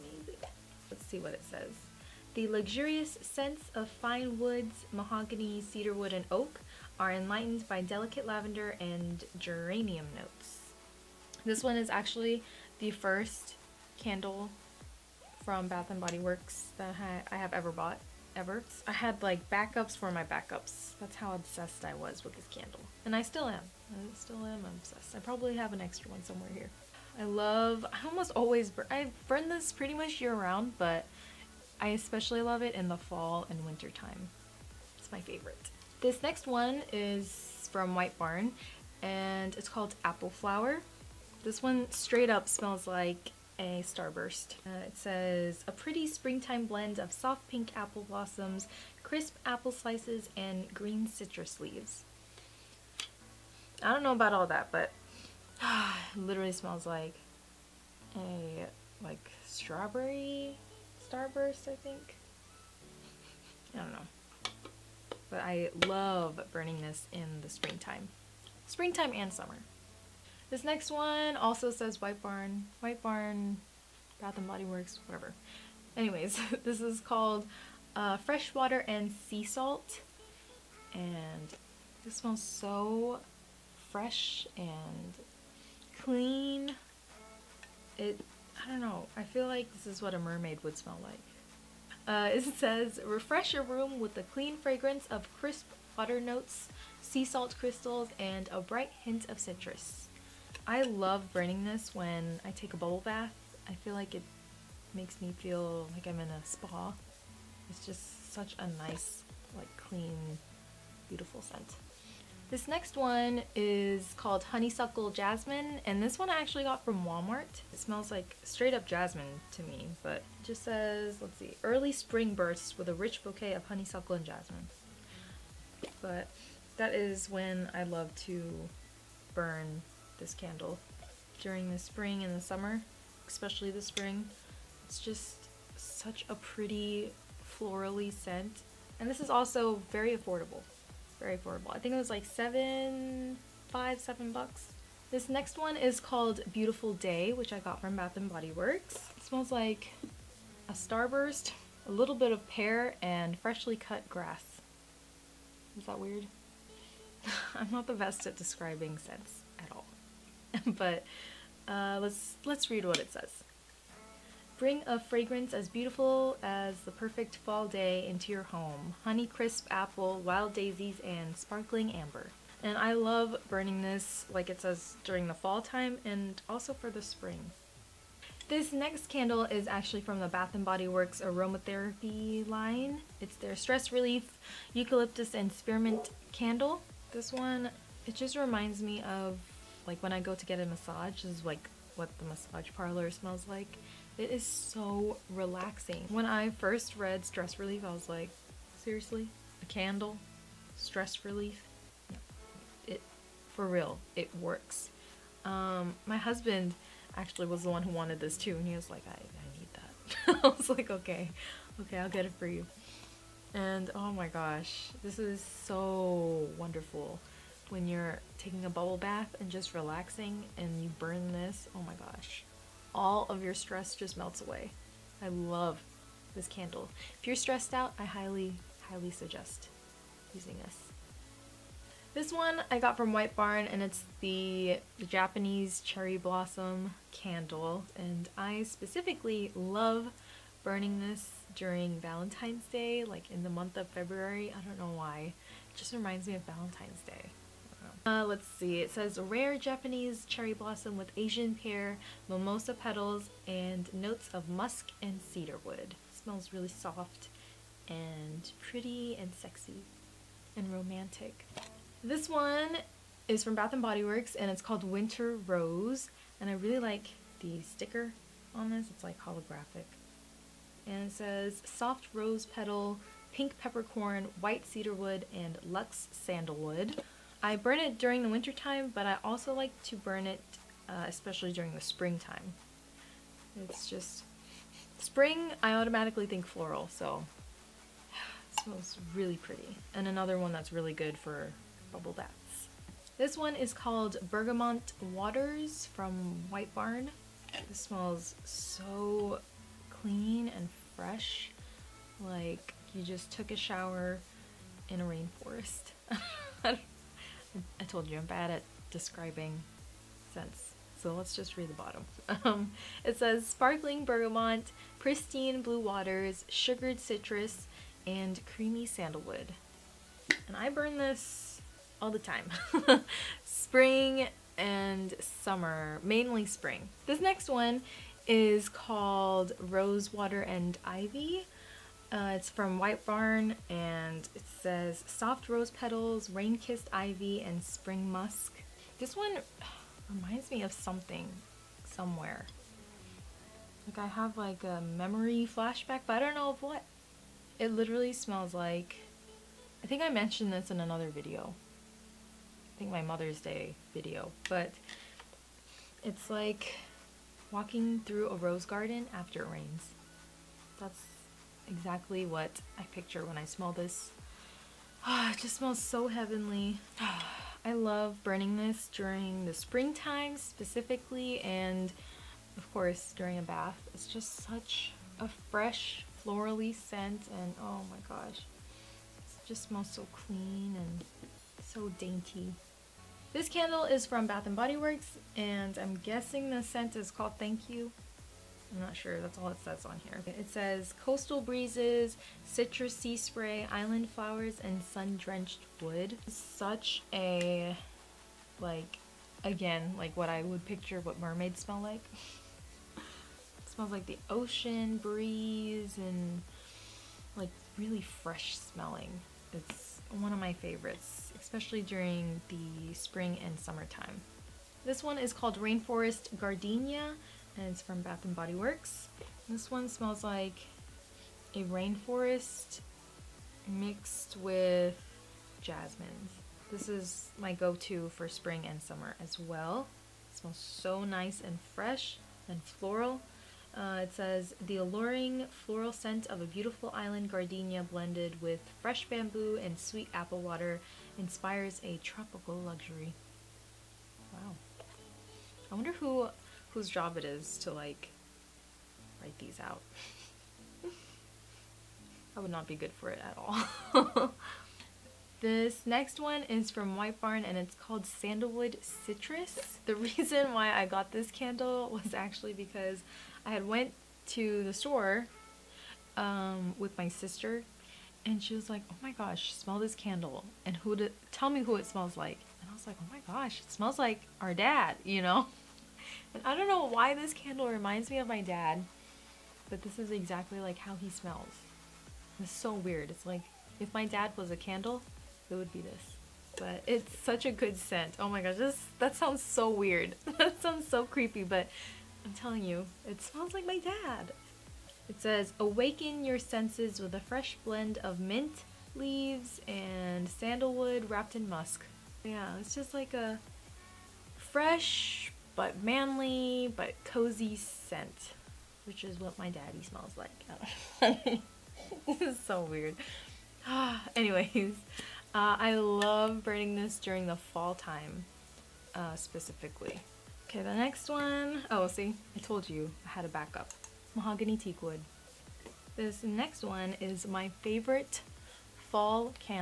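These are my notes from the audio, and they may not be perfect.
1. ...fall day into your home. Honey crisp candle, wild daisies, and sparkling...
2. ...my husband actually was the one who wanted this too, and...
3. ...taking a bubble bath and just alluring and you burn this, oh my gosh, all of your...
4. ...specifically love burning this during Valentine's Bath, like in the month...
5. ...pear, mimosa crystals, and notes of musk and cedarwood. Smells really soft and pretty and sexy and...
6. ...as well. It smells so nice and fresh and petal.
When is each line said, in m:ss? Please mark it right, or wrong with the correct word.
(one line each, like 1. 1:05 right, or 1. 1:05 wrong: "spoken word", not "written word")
1. 2:47 wrong: "apple", not "candle"
2. 3:26 right
3. 3:38 wrong: "relaxing", not "alluring"
4. 3:58 wrong: "Day", not "Bath"
5. 4:11 wrong: "petals", not "crystals"
6. 7:09 wrong: "floral", not "petal".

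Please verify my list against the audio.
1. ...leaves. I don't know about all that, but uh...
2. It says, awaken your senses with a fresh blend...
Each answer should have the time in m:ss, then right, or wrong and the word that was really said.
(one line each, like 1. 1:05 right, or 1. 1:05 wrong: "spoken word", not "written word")
1. 0:51 right
2. 8:15 right.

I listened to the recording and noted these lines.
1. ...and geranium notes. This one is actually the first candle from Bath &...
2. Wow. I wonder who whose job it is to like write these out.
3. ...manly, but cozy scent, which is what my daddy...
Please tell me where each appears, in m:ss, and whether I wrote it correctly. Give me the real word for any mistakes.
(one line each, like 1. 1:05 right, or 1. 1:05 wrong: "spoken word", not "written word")
1. 0:08 right
2. 7:24 right
3. 8:25 right.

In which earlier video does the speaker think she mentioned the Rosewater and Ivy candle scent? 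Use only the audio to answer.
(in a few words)
Mother's Day video.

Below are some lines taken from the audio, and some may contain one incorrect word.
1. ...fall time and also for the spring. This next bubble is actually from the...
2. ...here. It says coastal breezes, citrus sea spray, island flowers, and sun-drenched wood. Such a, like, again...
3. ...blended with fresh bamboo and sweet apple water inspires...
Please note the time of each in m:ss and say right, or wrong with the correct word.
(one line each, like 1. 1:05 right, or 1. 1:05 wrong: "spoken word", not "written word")
1. 2:55 wrong: "candle", not "bubble"
2. 6:30 right
3. 7:17 right.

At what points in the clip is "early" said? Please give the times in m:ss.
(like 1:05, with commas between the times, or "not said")
2:01.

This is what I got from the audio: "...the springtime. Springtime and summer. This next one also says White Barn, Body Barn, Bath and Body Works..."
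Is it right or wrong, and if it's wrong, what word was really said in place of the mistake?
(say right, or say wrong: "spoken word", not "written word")
wrong: "White", not "Body".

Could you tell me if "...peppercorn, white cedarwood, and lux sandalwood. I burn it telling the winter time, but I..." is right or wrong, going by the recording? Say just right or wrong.
wrong.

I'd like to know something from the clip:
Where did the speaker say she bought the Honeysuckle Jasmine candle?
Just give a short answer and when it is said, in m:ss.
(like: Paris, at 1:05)
Walmart, at 1:57.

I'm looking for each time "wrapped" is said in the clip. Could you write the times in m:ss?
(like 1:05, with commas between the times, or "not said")
8:21.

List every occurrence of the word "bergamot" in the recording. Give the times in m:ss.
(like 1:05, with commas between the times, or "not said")
4:54, 5:14.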